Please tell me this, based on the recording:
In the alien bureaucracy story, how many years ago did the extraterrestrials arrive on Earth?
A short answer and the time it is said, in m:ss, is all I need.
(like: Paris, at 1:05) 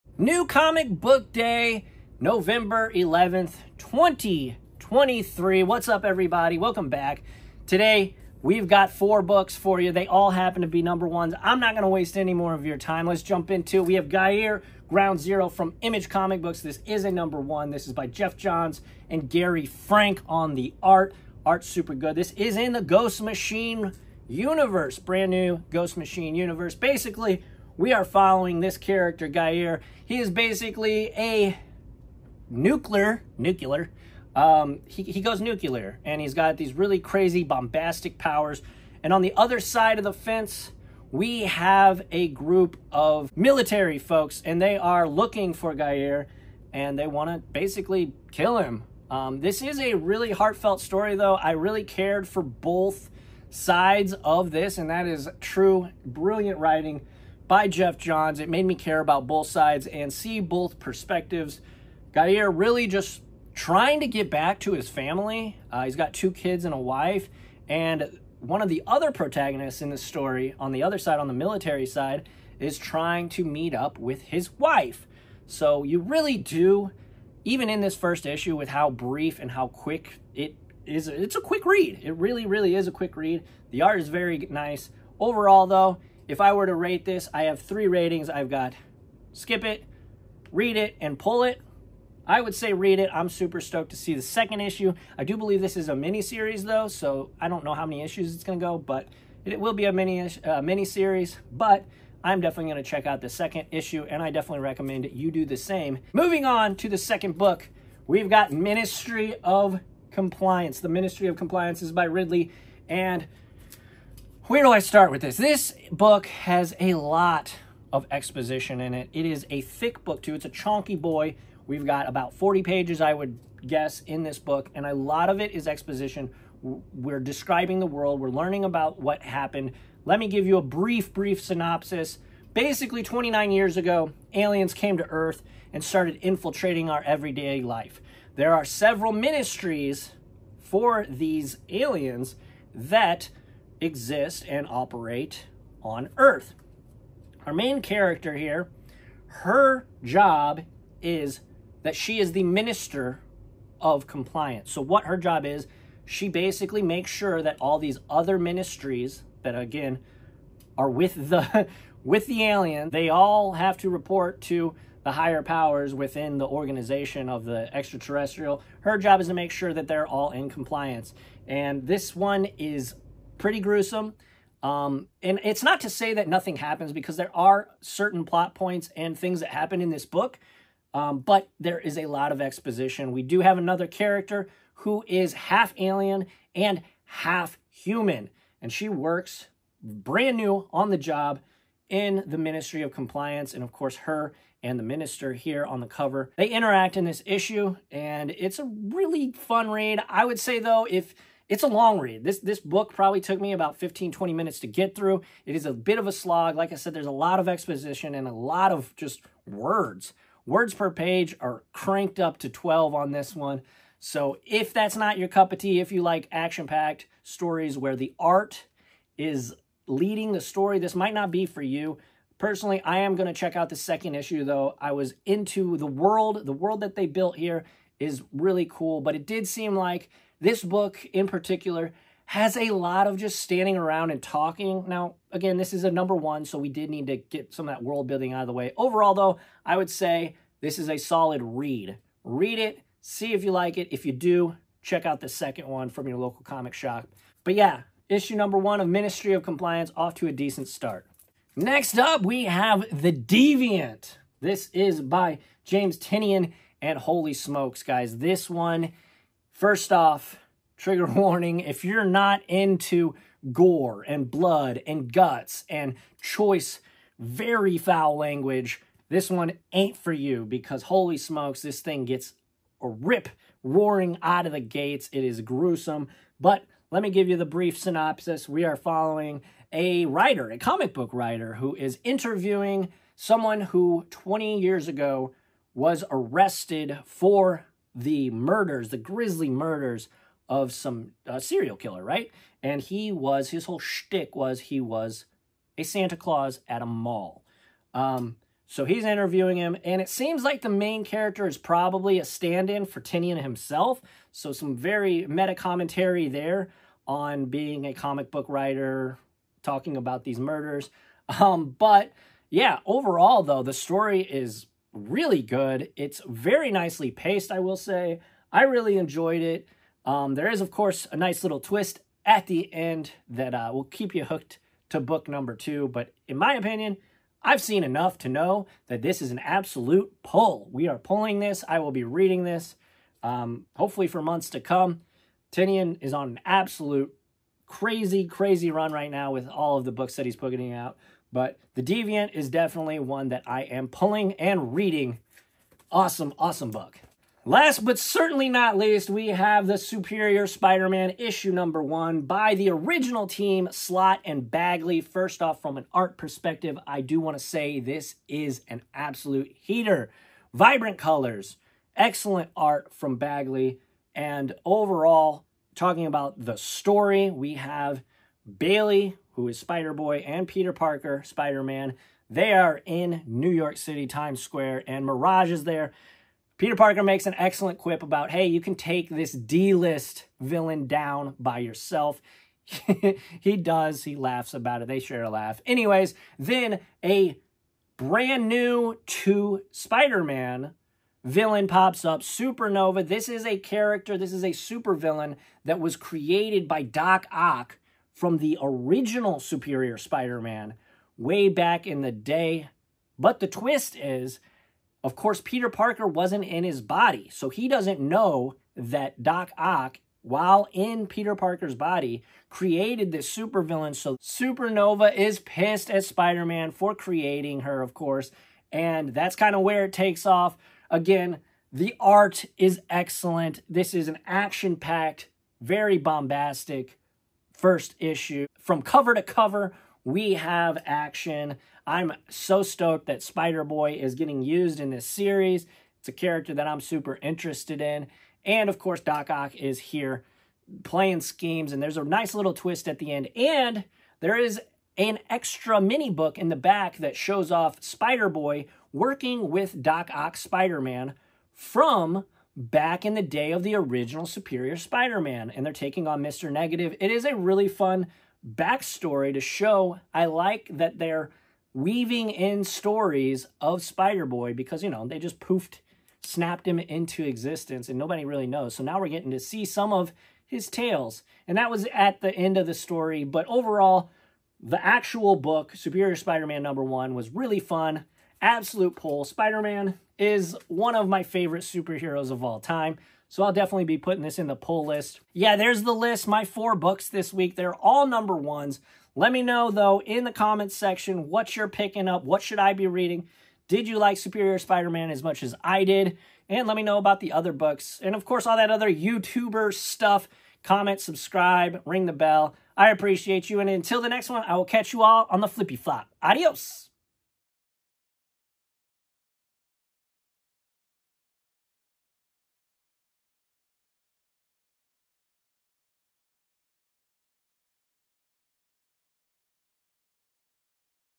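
29, at 2:13.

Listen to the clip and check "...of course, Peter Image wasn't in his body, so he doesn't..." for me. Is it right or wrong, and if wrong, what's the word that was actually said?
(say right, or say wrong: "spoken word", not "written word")
wrong: "Parker", not "Image".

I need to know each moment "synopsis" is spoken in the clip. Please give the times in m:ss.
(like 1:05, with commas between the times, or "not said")
2:11, 4:37.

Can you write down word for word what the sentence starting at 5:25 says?
But in my opinion, I've seen enough to know that this is an absolute pull.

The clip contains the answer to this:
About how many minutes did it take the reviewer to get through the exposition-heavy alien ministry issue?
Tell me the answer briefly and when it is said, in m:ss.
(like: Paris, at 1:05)
15 to 20 minutes, at 3:23.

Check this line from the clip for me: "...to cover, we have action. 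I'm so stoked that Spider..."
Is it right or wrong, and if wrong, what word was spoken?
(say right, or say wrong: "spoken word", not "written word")
right.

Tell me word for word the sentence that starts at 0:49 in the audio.
Um, this is a really heartfelt story, though.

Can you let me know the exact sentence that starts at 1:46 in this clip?
Moving on to the second book, we've got Ministry of Compliance.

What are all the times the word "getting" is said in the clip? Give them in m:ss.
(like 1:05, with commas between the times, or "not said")
7:14, 7:49.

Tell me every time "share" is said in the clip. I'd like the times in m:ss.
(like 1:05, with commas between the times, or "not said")
6:24.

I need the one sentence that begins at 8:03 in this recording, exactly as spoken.
So I'll definitely be putting this in the pull list.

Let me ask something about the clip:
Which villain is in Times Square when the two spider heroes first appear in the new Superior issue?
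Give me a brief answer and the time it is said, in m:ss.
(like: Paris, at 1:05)
Mirage, at 6:15.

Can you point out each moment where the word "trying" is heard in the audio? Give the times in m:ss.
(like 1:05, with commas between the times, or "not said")
1:03, 1:12.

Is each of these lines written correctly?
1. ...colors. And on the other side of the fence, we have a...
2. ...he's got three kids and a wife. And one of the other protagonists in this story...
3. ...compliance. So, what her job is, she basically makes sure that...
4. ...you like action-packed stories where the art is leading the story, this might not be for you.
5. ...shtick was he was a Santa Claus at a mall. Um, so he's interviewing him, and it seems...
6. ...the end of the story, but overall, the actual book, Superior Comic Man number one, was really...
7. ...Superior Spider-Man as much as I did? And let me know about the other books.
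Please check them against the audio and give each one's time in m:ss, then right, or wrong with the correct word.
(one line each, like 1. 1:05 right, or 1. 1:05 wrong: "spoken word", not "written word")
1. 0:38 wrong: "powers", not "colors"
2. 1:05 wrong: "two", not "three"
3. 2:34 right
4. 3:35 right
5. 4:53 right
6. 7:52 wrong: "Spider", not "Comic"
7. 8:14 right.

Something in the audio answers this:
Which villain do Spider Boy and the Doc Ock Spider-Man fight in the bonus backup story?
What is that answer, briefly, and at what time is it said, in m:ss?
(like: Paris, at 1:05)
Mr. Negative, at 7:36.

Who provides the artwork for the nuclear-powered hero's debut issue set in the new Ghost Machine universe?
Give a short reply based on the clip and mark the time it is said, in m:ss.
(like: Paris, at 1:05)
Gary Frank, at 0:19.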